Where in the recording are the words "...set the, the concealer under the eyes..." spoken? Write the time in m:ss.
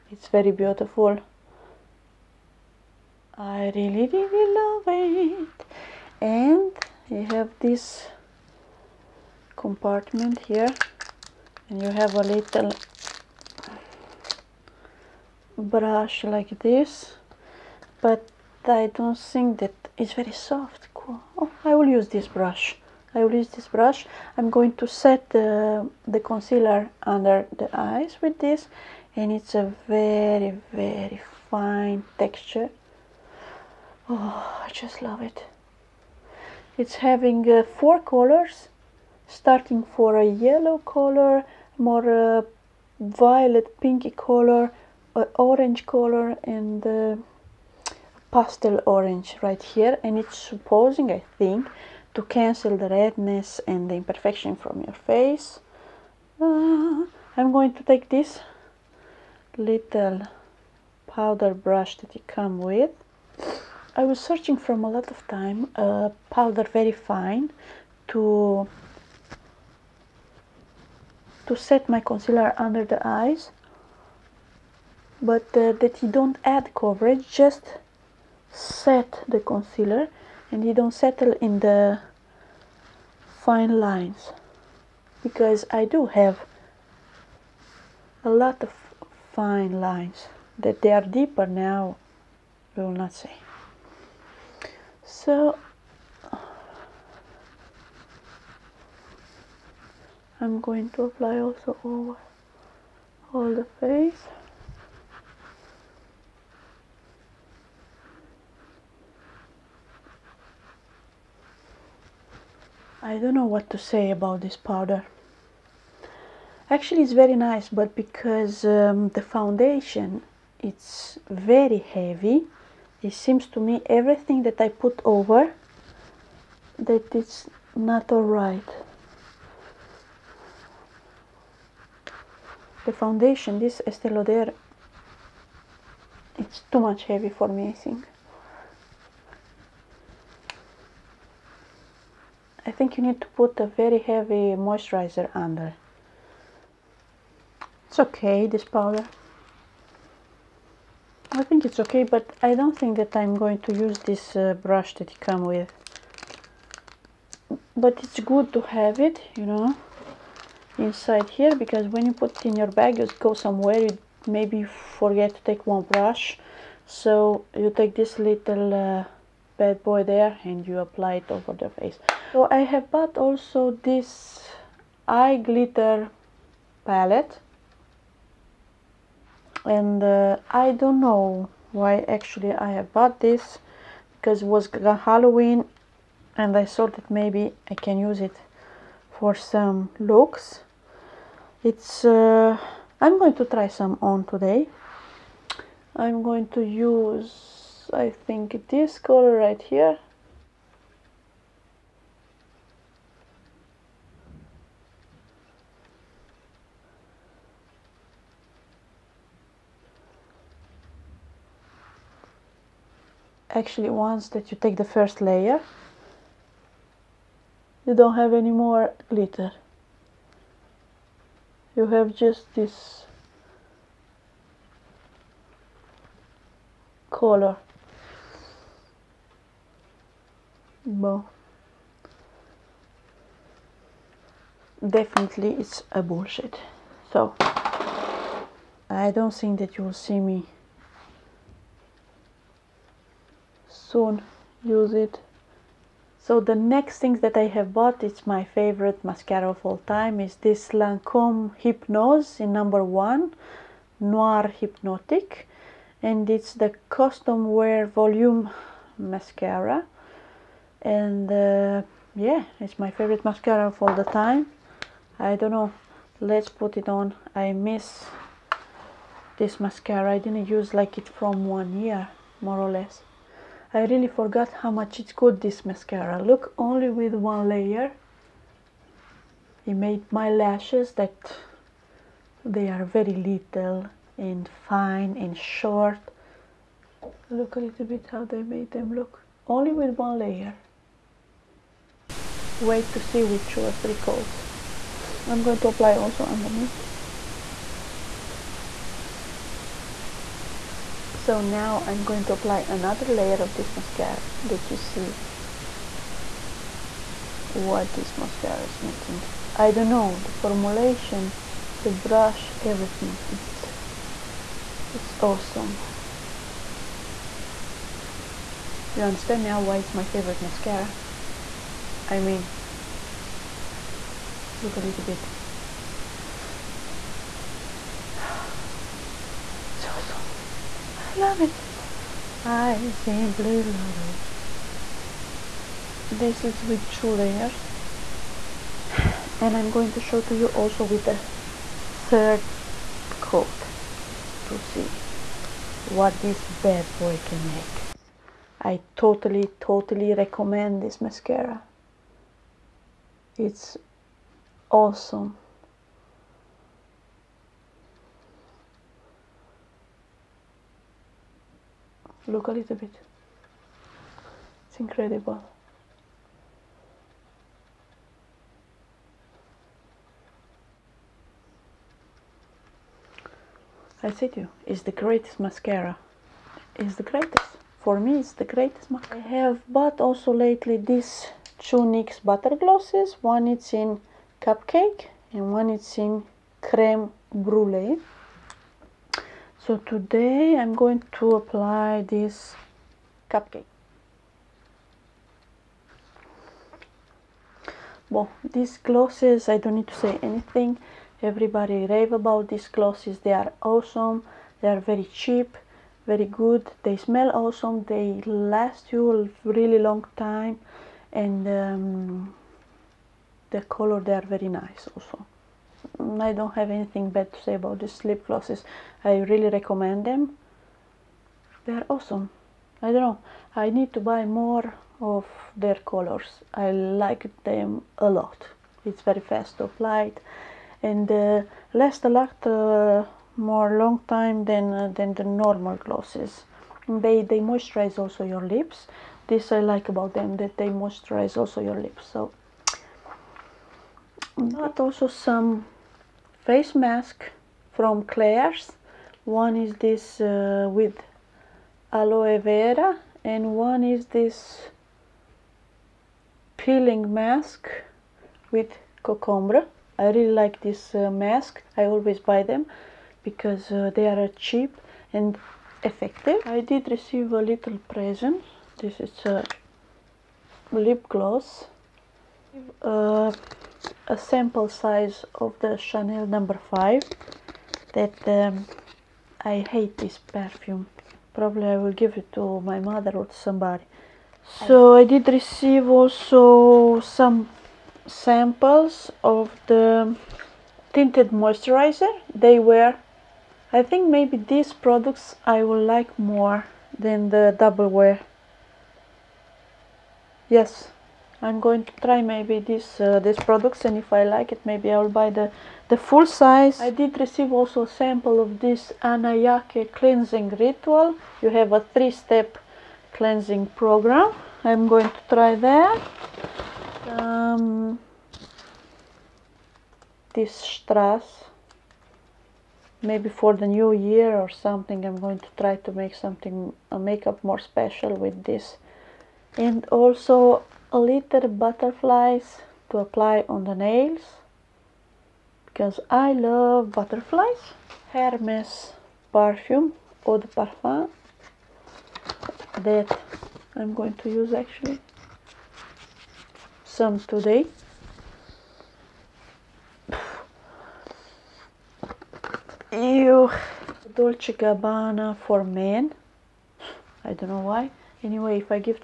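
0:24.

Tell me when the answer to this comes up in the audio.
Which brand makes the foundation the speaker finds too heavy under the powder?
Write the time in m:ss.
2:13.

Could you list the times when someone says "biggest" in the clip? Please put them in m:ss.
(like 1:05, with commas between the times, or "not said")
not said.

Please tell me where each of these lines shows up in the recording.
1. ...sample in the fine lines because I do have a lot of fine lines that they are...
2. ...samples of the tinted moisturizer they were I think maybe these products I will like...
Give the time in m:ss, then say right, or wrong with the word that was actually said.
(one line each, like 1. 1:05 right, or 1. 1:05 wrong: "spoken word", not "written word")
1. 1:20 wrong: "settle", not "sample"
2. 8:08 right.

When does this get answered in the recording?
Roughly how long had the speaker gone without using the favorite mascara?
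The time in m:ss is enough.
4:31.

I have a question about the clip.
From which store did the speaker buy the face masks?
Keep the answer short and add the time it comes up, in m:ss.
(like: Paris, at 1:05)
Claire's, at 7:28.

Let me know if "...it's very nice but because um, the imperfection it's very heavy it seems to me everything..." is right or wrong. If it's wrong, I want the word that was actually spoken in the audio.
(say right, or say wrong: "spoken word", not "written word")
wrong: "foundation", not "imperfection".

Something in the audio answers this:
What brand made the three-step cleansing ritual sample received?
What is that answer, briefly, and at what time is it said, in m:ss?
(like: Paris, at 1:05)
Annayake, at 8:29.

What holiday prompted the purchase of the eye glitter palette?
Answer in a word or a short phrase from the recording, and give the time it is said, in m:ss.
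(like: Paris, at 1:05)
Halloween, at 3:05.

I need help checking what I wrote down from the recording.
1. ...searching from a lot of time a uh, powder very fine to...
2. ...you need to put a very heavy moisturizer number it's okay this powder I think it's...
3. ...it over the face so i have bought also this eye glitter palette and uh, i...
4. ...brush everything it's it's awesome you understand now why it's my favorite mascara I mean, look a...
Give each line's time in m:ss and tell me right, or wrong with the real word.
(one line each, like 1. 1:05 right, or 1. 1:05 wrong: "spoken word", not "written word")
1. 1:04 right
2. 2:22 wrong: "under", not "number"
3. 2:51 right
4. 5:11 right.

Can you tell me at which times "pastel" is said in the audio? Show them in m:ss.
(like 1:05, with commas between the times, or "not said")
0:48.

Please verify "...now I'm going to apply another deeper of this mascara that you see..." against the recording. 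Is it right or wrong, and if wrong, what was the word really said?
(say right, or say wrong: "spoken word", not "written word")
wrong: "layer", not "deeper".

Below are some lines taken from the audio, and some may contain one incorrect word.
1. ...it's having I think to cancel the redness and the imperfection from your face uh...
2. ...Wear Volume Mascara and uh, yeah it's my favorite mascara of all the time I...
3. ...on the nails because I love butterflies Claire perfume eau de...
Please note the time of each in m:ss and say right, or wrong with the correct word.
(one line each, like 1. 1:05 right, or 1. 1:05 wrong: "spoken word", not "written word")
1. 0:50 wrong: "supposing", not "having"
2. 4:17 right
3. 8:53 wrong: "Hermes", not "Claire".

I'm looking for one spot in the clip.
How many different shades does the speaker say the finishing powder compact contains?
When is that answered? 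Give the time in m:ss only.
0:37.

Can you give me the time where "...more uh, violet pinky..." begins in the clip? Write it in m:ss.
0:41.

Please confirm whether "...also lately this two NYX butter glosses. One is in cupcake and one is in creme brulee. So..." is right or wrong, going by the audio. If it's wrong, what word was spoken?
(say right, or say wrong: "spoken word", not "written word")
right.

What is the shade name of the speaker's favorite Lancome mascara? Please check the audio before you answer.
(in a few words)
Noir Hypnotic.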